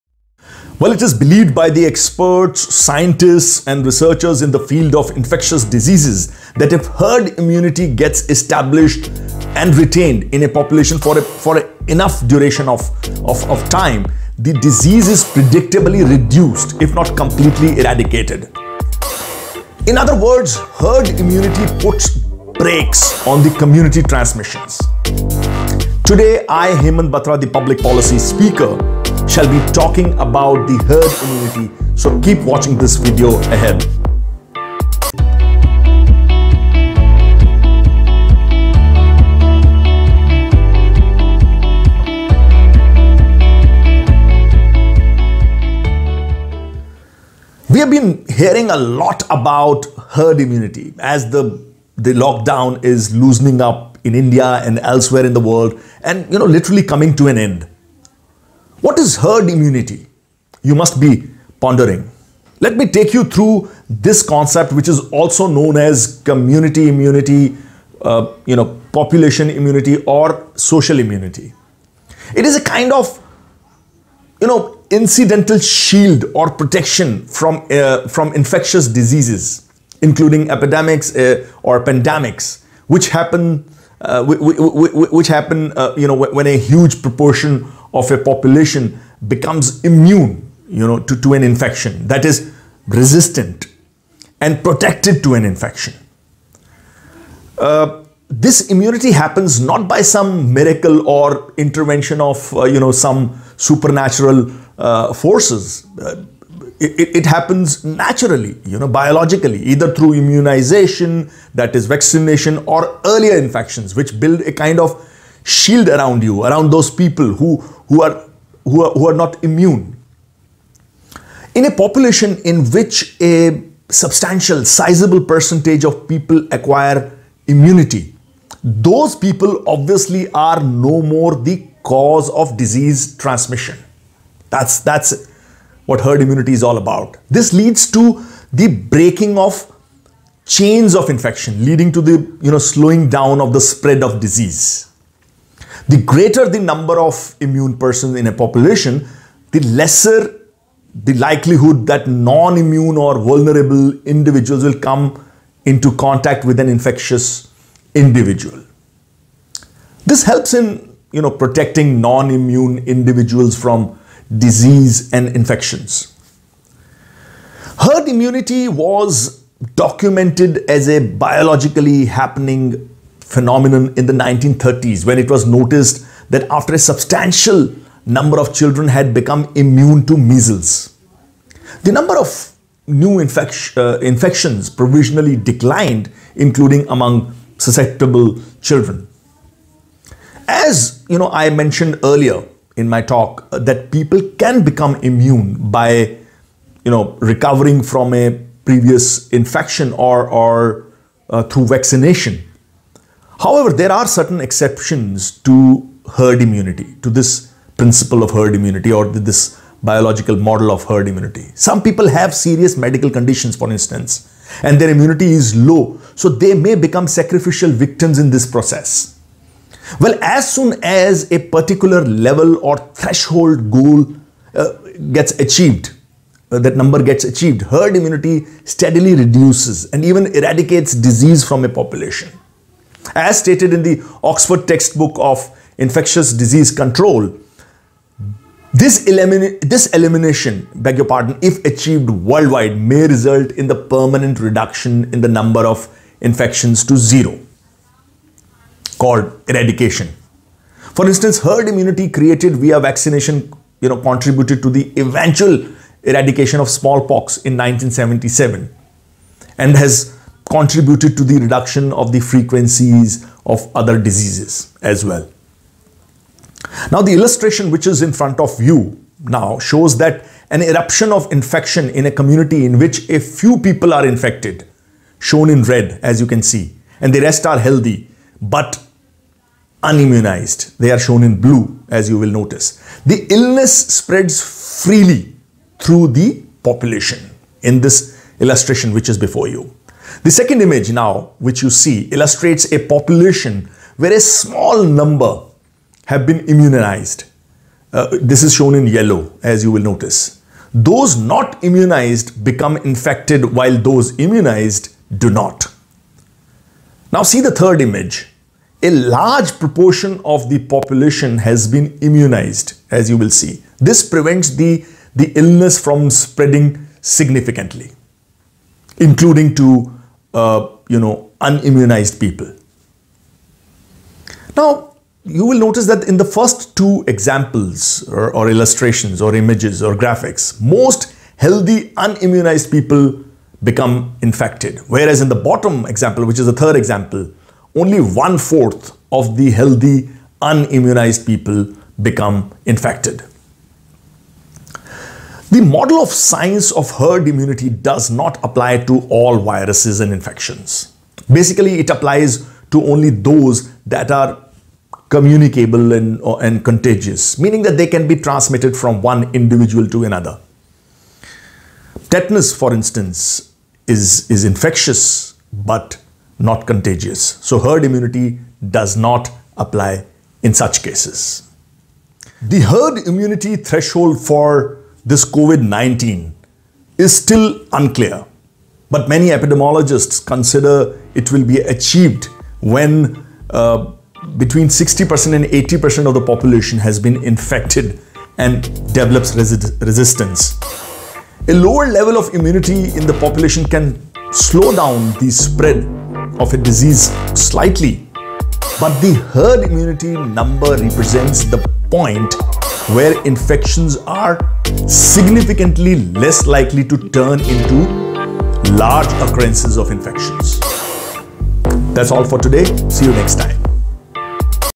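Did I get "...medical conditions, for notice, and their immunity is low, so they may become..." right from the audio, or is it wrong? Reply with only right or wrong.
wrong.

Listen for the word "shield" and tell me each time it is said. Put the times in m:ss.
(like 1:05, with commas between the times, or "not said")
1:15, 1:55.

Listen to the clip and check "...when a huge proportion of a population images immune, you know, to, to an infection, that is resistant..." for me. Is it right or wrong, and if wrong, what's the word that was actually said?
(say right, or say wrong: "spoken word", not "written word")
wrong: "becomes", not "images".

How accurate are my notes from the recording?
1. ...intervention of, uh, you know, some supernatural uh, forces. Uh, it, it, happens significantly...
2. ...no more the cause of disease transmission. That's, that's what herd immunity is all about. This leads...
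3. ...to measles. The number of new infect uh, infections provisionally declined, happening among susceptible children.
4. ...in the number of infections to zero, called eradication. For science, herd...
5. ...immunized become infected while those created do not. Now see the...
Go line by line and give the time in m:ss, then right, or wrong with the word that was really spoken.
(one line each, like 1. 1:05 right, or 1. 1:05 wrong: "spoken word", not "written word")
1. 1:41 wrong: "naturally", not "significantly"
2. 2:10 right
3. 3:00 wrong: "including", not "happening"
4. 4:05 wrong: "instance", not "science"
5. 5:01 wrong: "immunized", not "created".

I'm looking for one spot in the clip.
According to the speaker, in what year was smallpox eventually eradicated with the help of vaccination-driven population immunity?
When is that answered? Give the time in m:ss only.
4:17.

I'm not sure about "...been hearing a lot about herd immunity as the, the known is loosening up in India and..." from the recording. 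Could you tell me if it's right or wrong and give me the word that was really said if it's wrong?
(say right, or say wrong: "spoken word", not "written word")
wrong: "lockdown", not "known".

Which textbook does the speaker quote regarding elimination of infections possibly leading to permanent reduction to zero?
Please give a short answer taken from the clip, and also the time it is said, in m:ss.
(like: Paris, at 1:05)
Oxford textbook of infectious disease control, at 3:54.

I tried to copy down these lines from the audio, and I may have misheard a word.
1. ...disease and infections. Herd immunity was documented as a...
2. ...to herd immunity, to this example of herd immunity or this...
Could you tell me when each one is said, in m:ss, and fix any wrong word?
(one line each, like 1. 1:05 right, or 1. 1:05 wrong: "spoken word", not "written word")
1. 2:44 right
2. 3:25 wrong: "principle", not "example".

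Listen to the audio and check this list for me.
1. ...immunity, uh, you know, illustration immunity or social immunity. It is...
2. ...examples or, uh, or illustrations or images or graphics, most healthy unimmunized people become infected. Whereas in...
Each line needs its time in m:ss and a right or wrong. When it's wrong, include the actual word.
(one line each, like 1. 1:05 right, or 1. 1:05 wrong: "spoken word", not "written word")
1. 1:06 wrong: "population", not "illustration"
2. 5:27 right.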